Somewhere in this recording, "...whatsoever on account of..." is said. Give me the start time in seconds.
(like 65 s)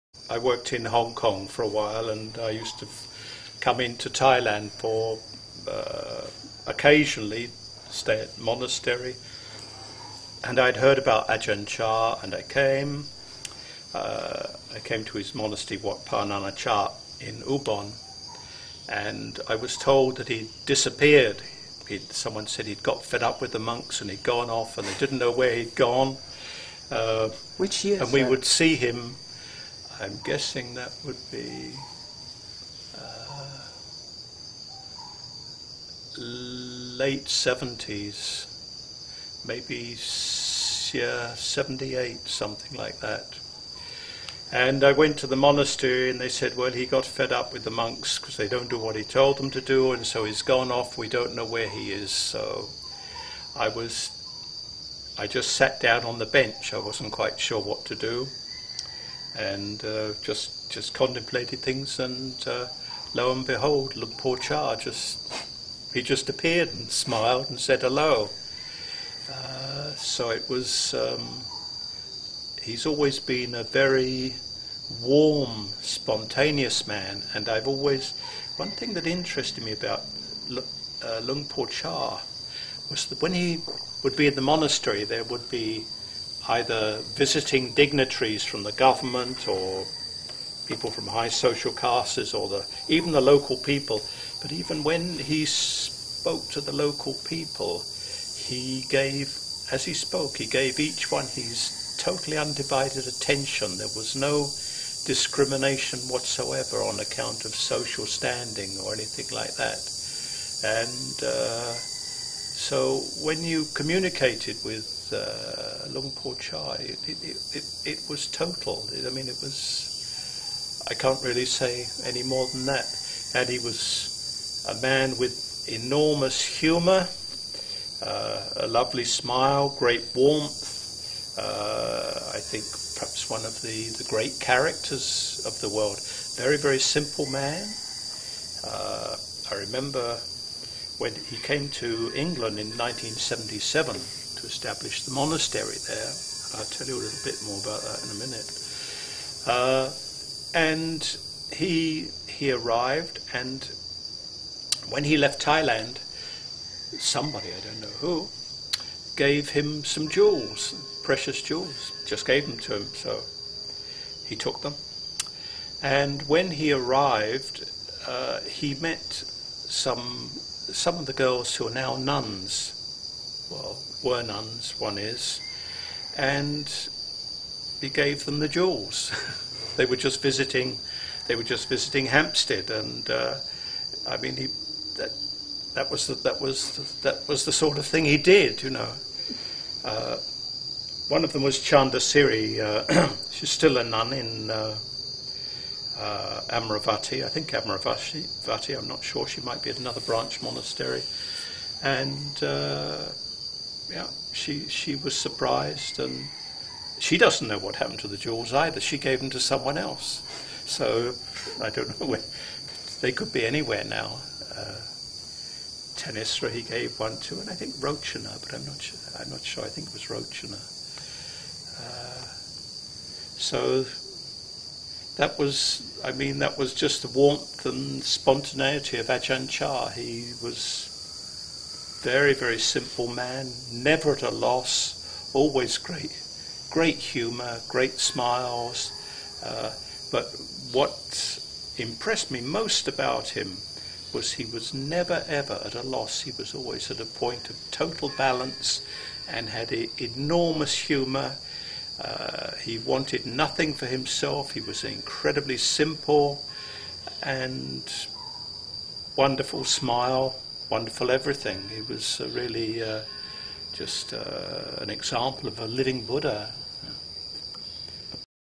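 106 s.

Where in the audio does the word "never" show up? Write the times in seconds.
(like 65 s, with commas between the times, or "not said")
233 s, 244 s.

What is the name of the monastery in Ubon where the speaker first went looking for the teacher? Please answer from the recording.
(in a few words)
Wat Pa Chah.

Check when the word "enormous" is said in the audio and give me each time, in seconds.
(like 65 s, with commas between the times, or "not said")
125 s, 249 s.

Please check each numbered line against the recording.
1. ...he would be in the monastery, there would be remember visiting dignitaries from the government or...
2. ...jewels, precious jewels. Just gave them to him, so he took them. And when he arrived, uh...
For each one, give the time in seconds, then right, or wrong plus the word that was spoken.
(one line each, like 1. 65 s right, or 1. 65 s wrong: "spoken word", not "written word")
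1. 83 s wrong: "either", not "remember"
2. 160 s right.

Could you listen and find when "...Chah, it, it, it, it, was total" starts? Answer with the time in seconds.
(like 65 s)
116 s.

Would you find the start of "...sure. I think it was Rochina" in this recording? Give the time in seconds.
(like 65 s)
219 s.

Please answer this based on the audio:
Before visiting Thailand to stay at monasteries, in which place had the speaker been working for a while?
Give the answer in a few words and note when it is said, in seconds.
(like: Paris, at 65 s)
Hong Kong, at 0 s.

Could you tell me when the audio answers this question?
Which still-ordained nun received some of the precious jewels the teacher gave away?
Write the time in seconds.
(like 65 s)
191 s.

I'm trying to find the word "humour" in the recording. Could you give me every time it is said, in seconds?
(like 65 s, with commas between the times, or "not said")
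126 s, 236 s, 250 s.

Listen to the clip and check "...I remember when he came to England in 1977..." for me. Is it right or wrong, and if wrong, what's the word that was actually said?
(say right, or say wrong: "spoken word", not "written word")
right.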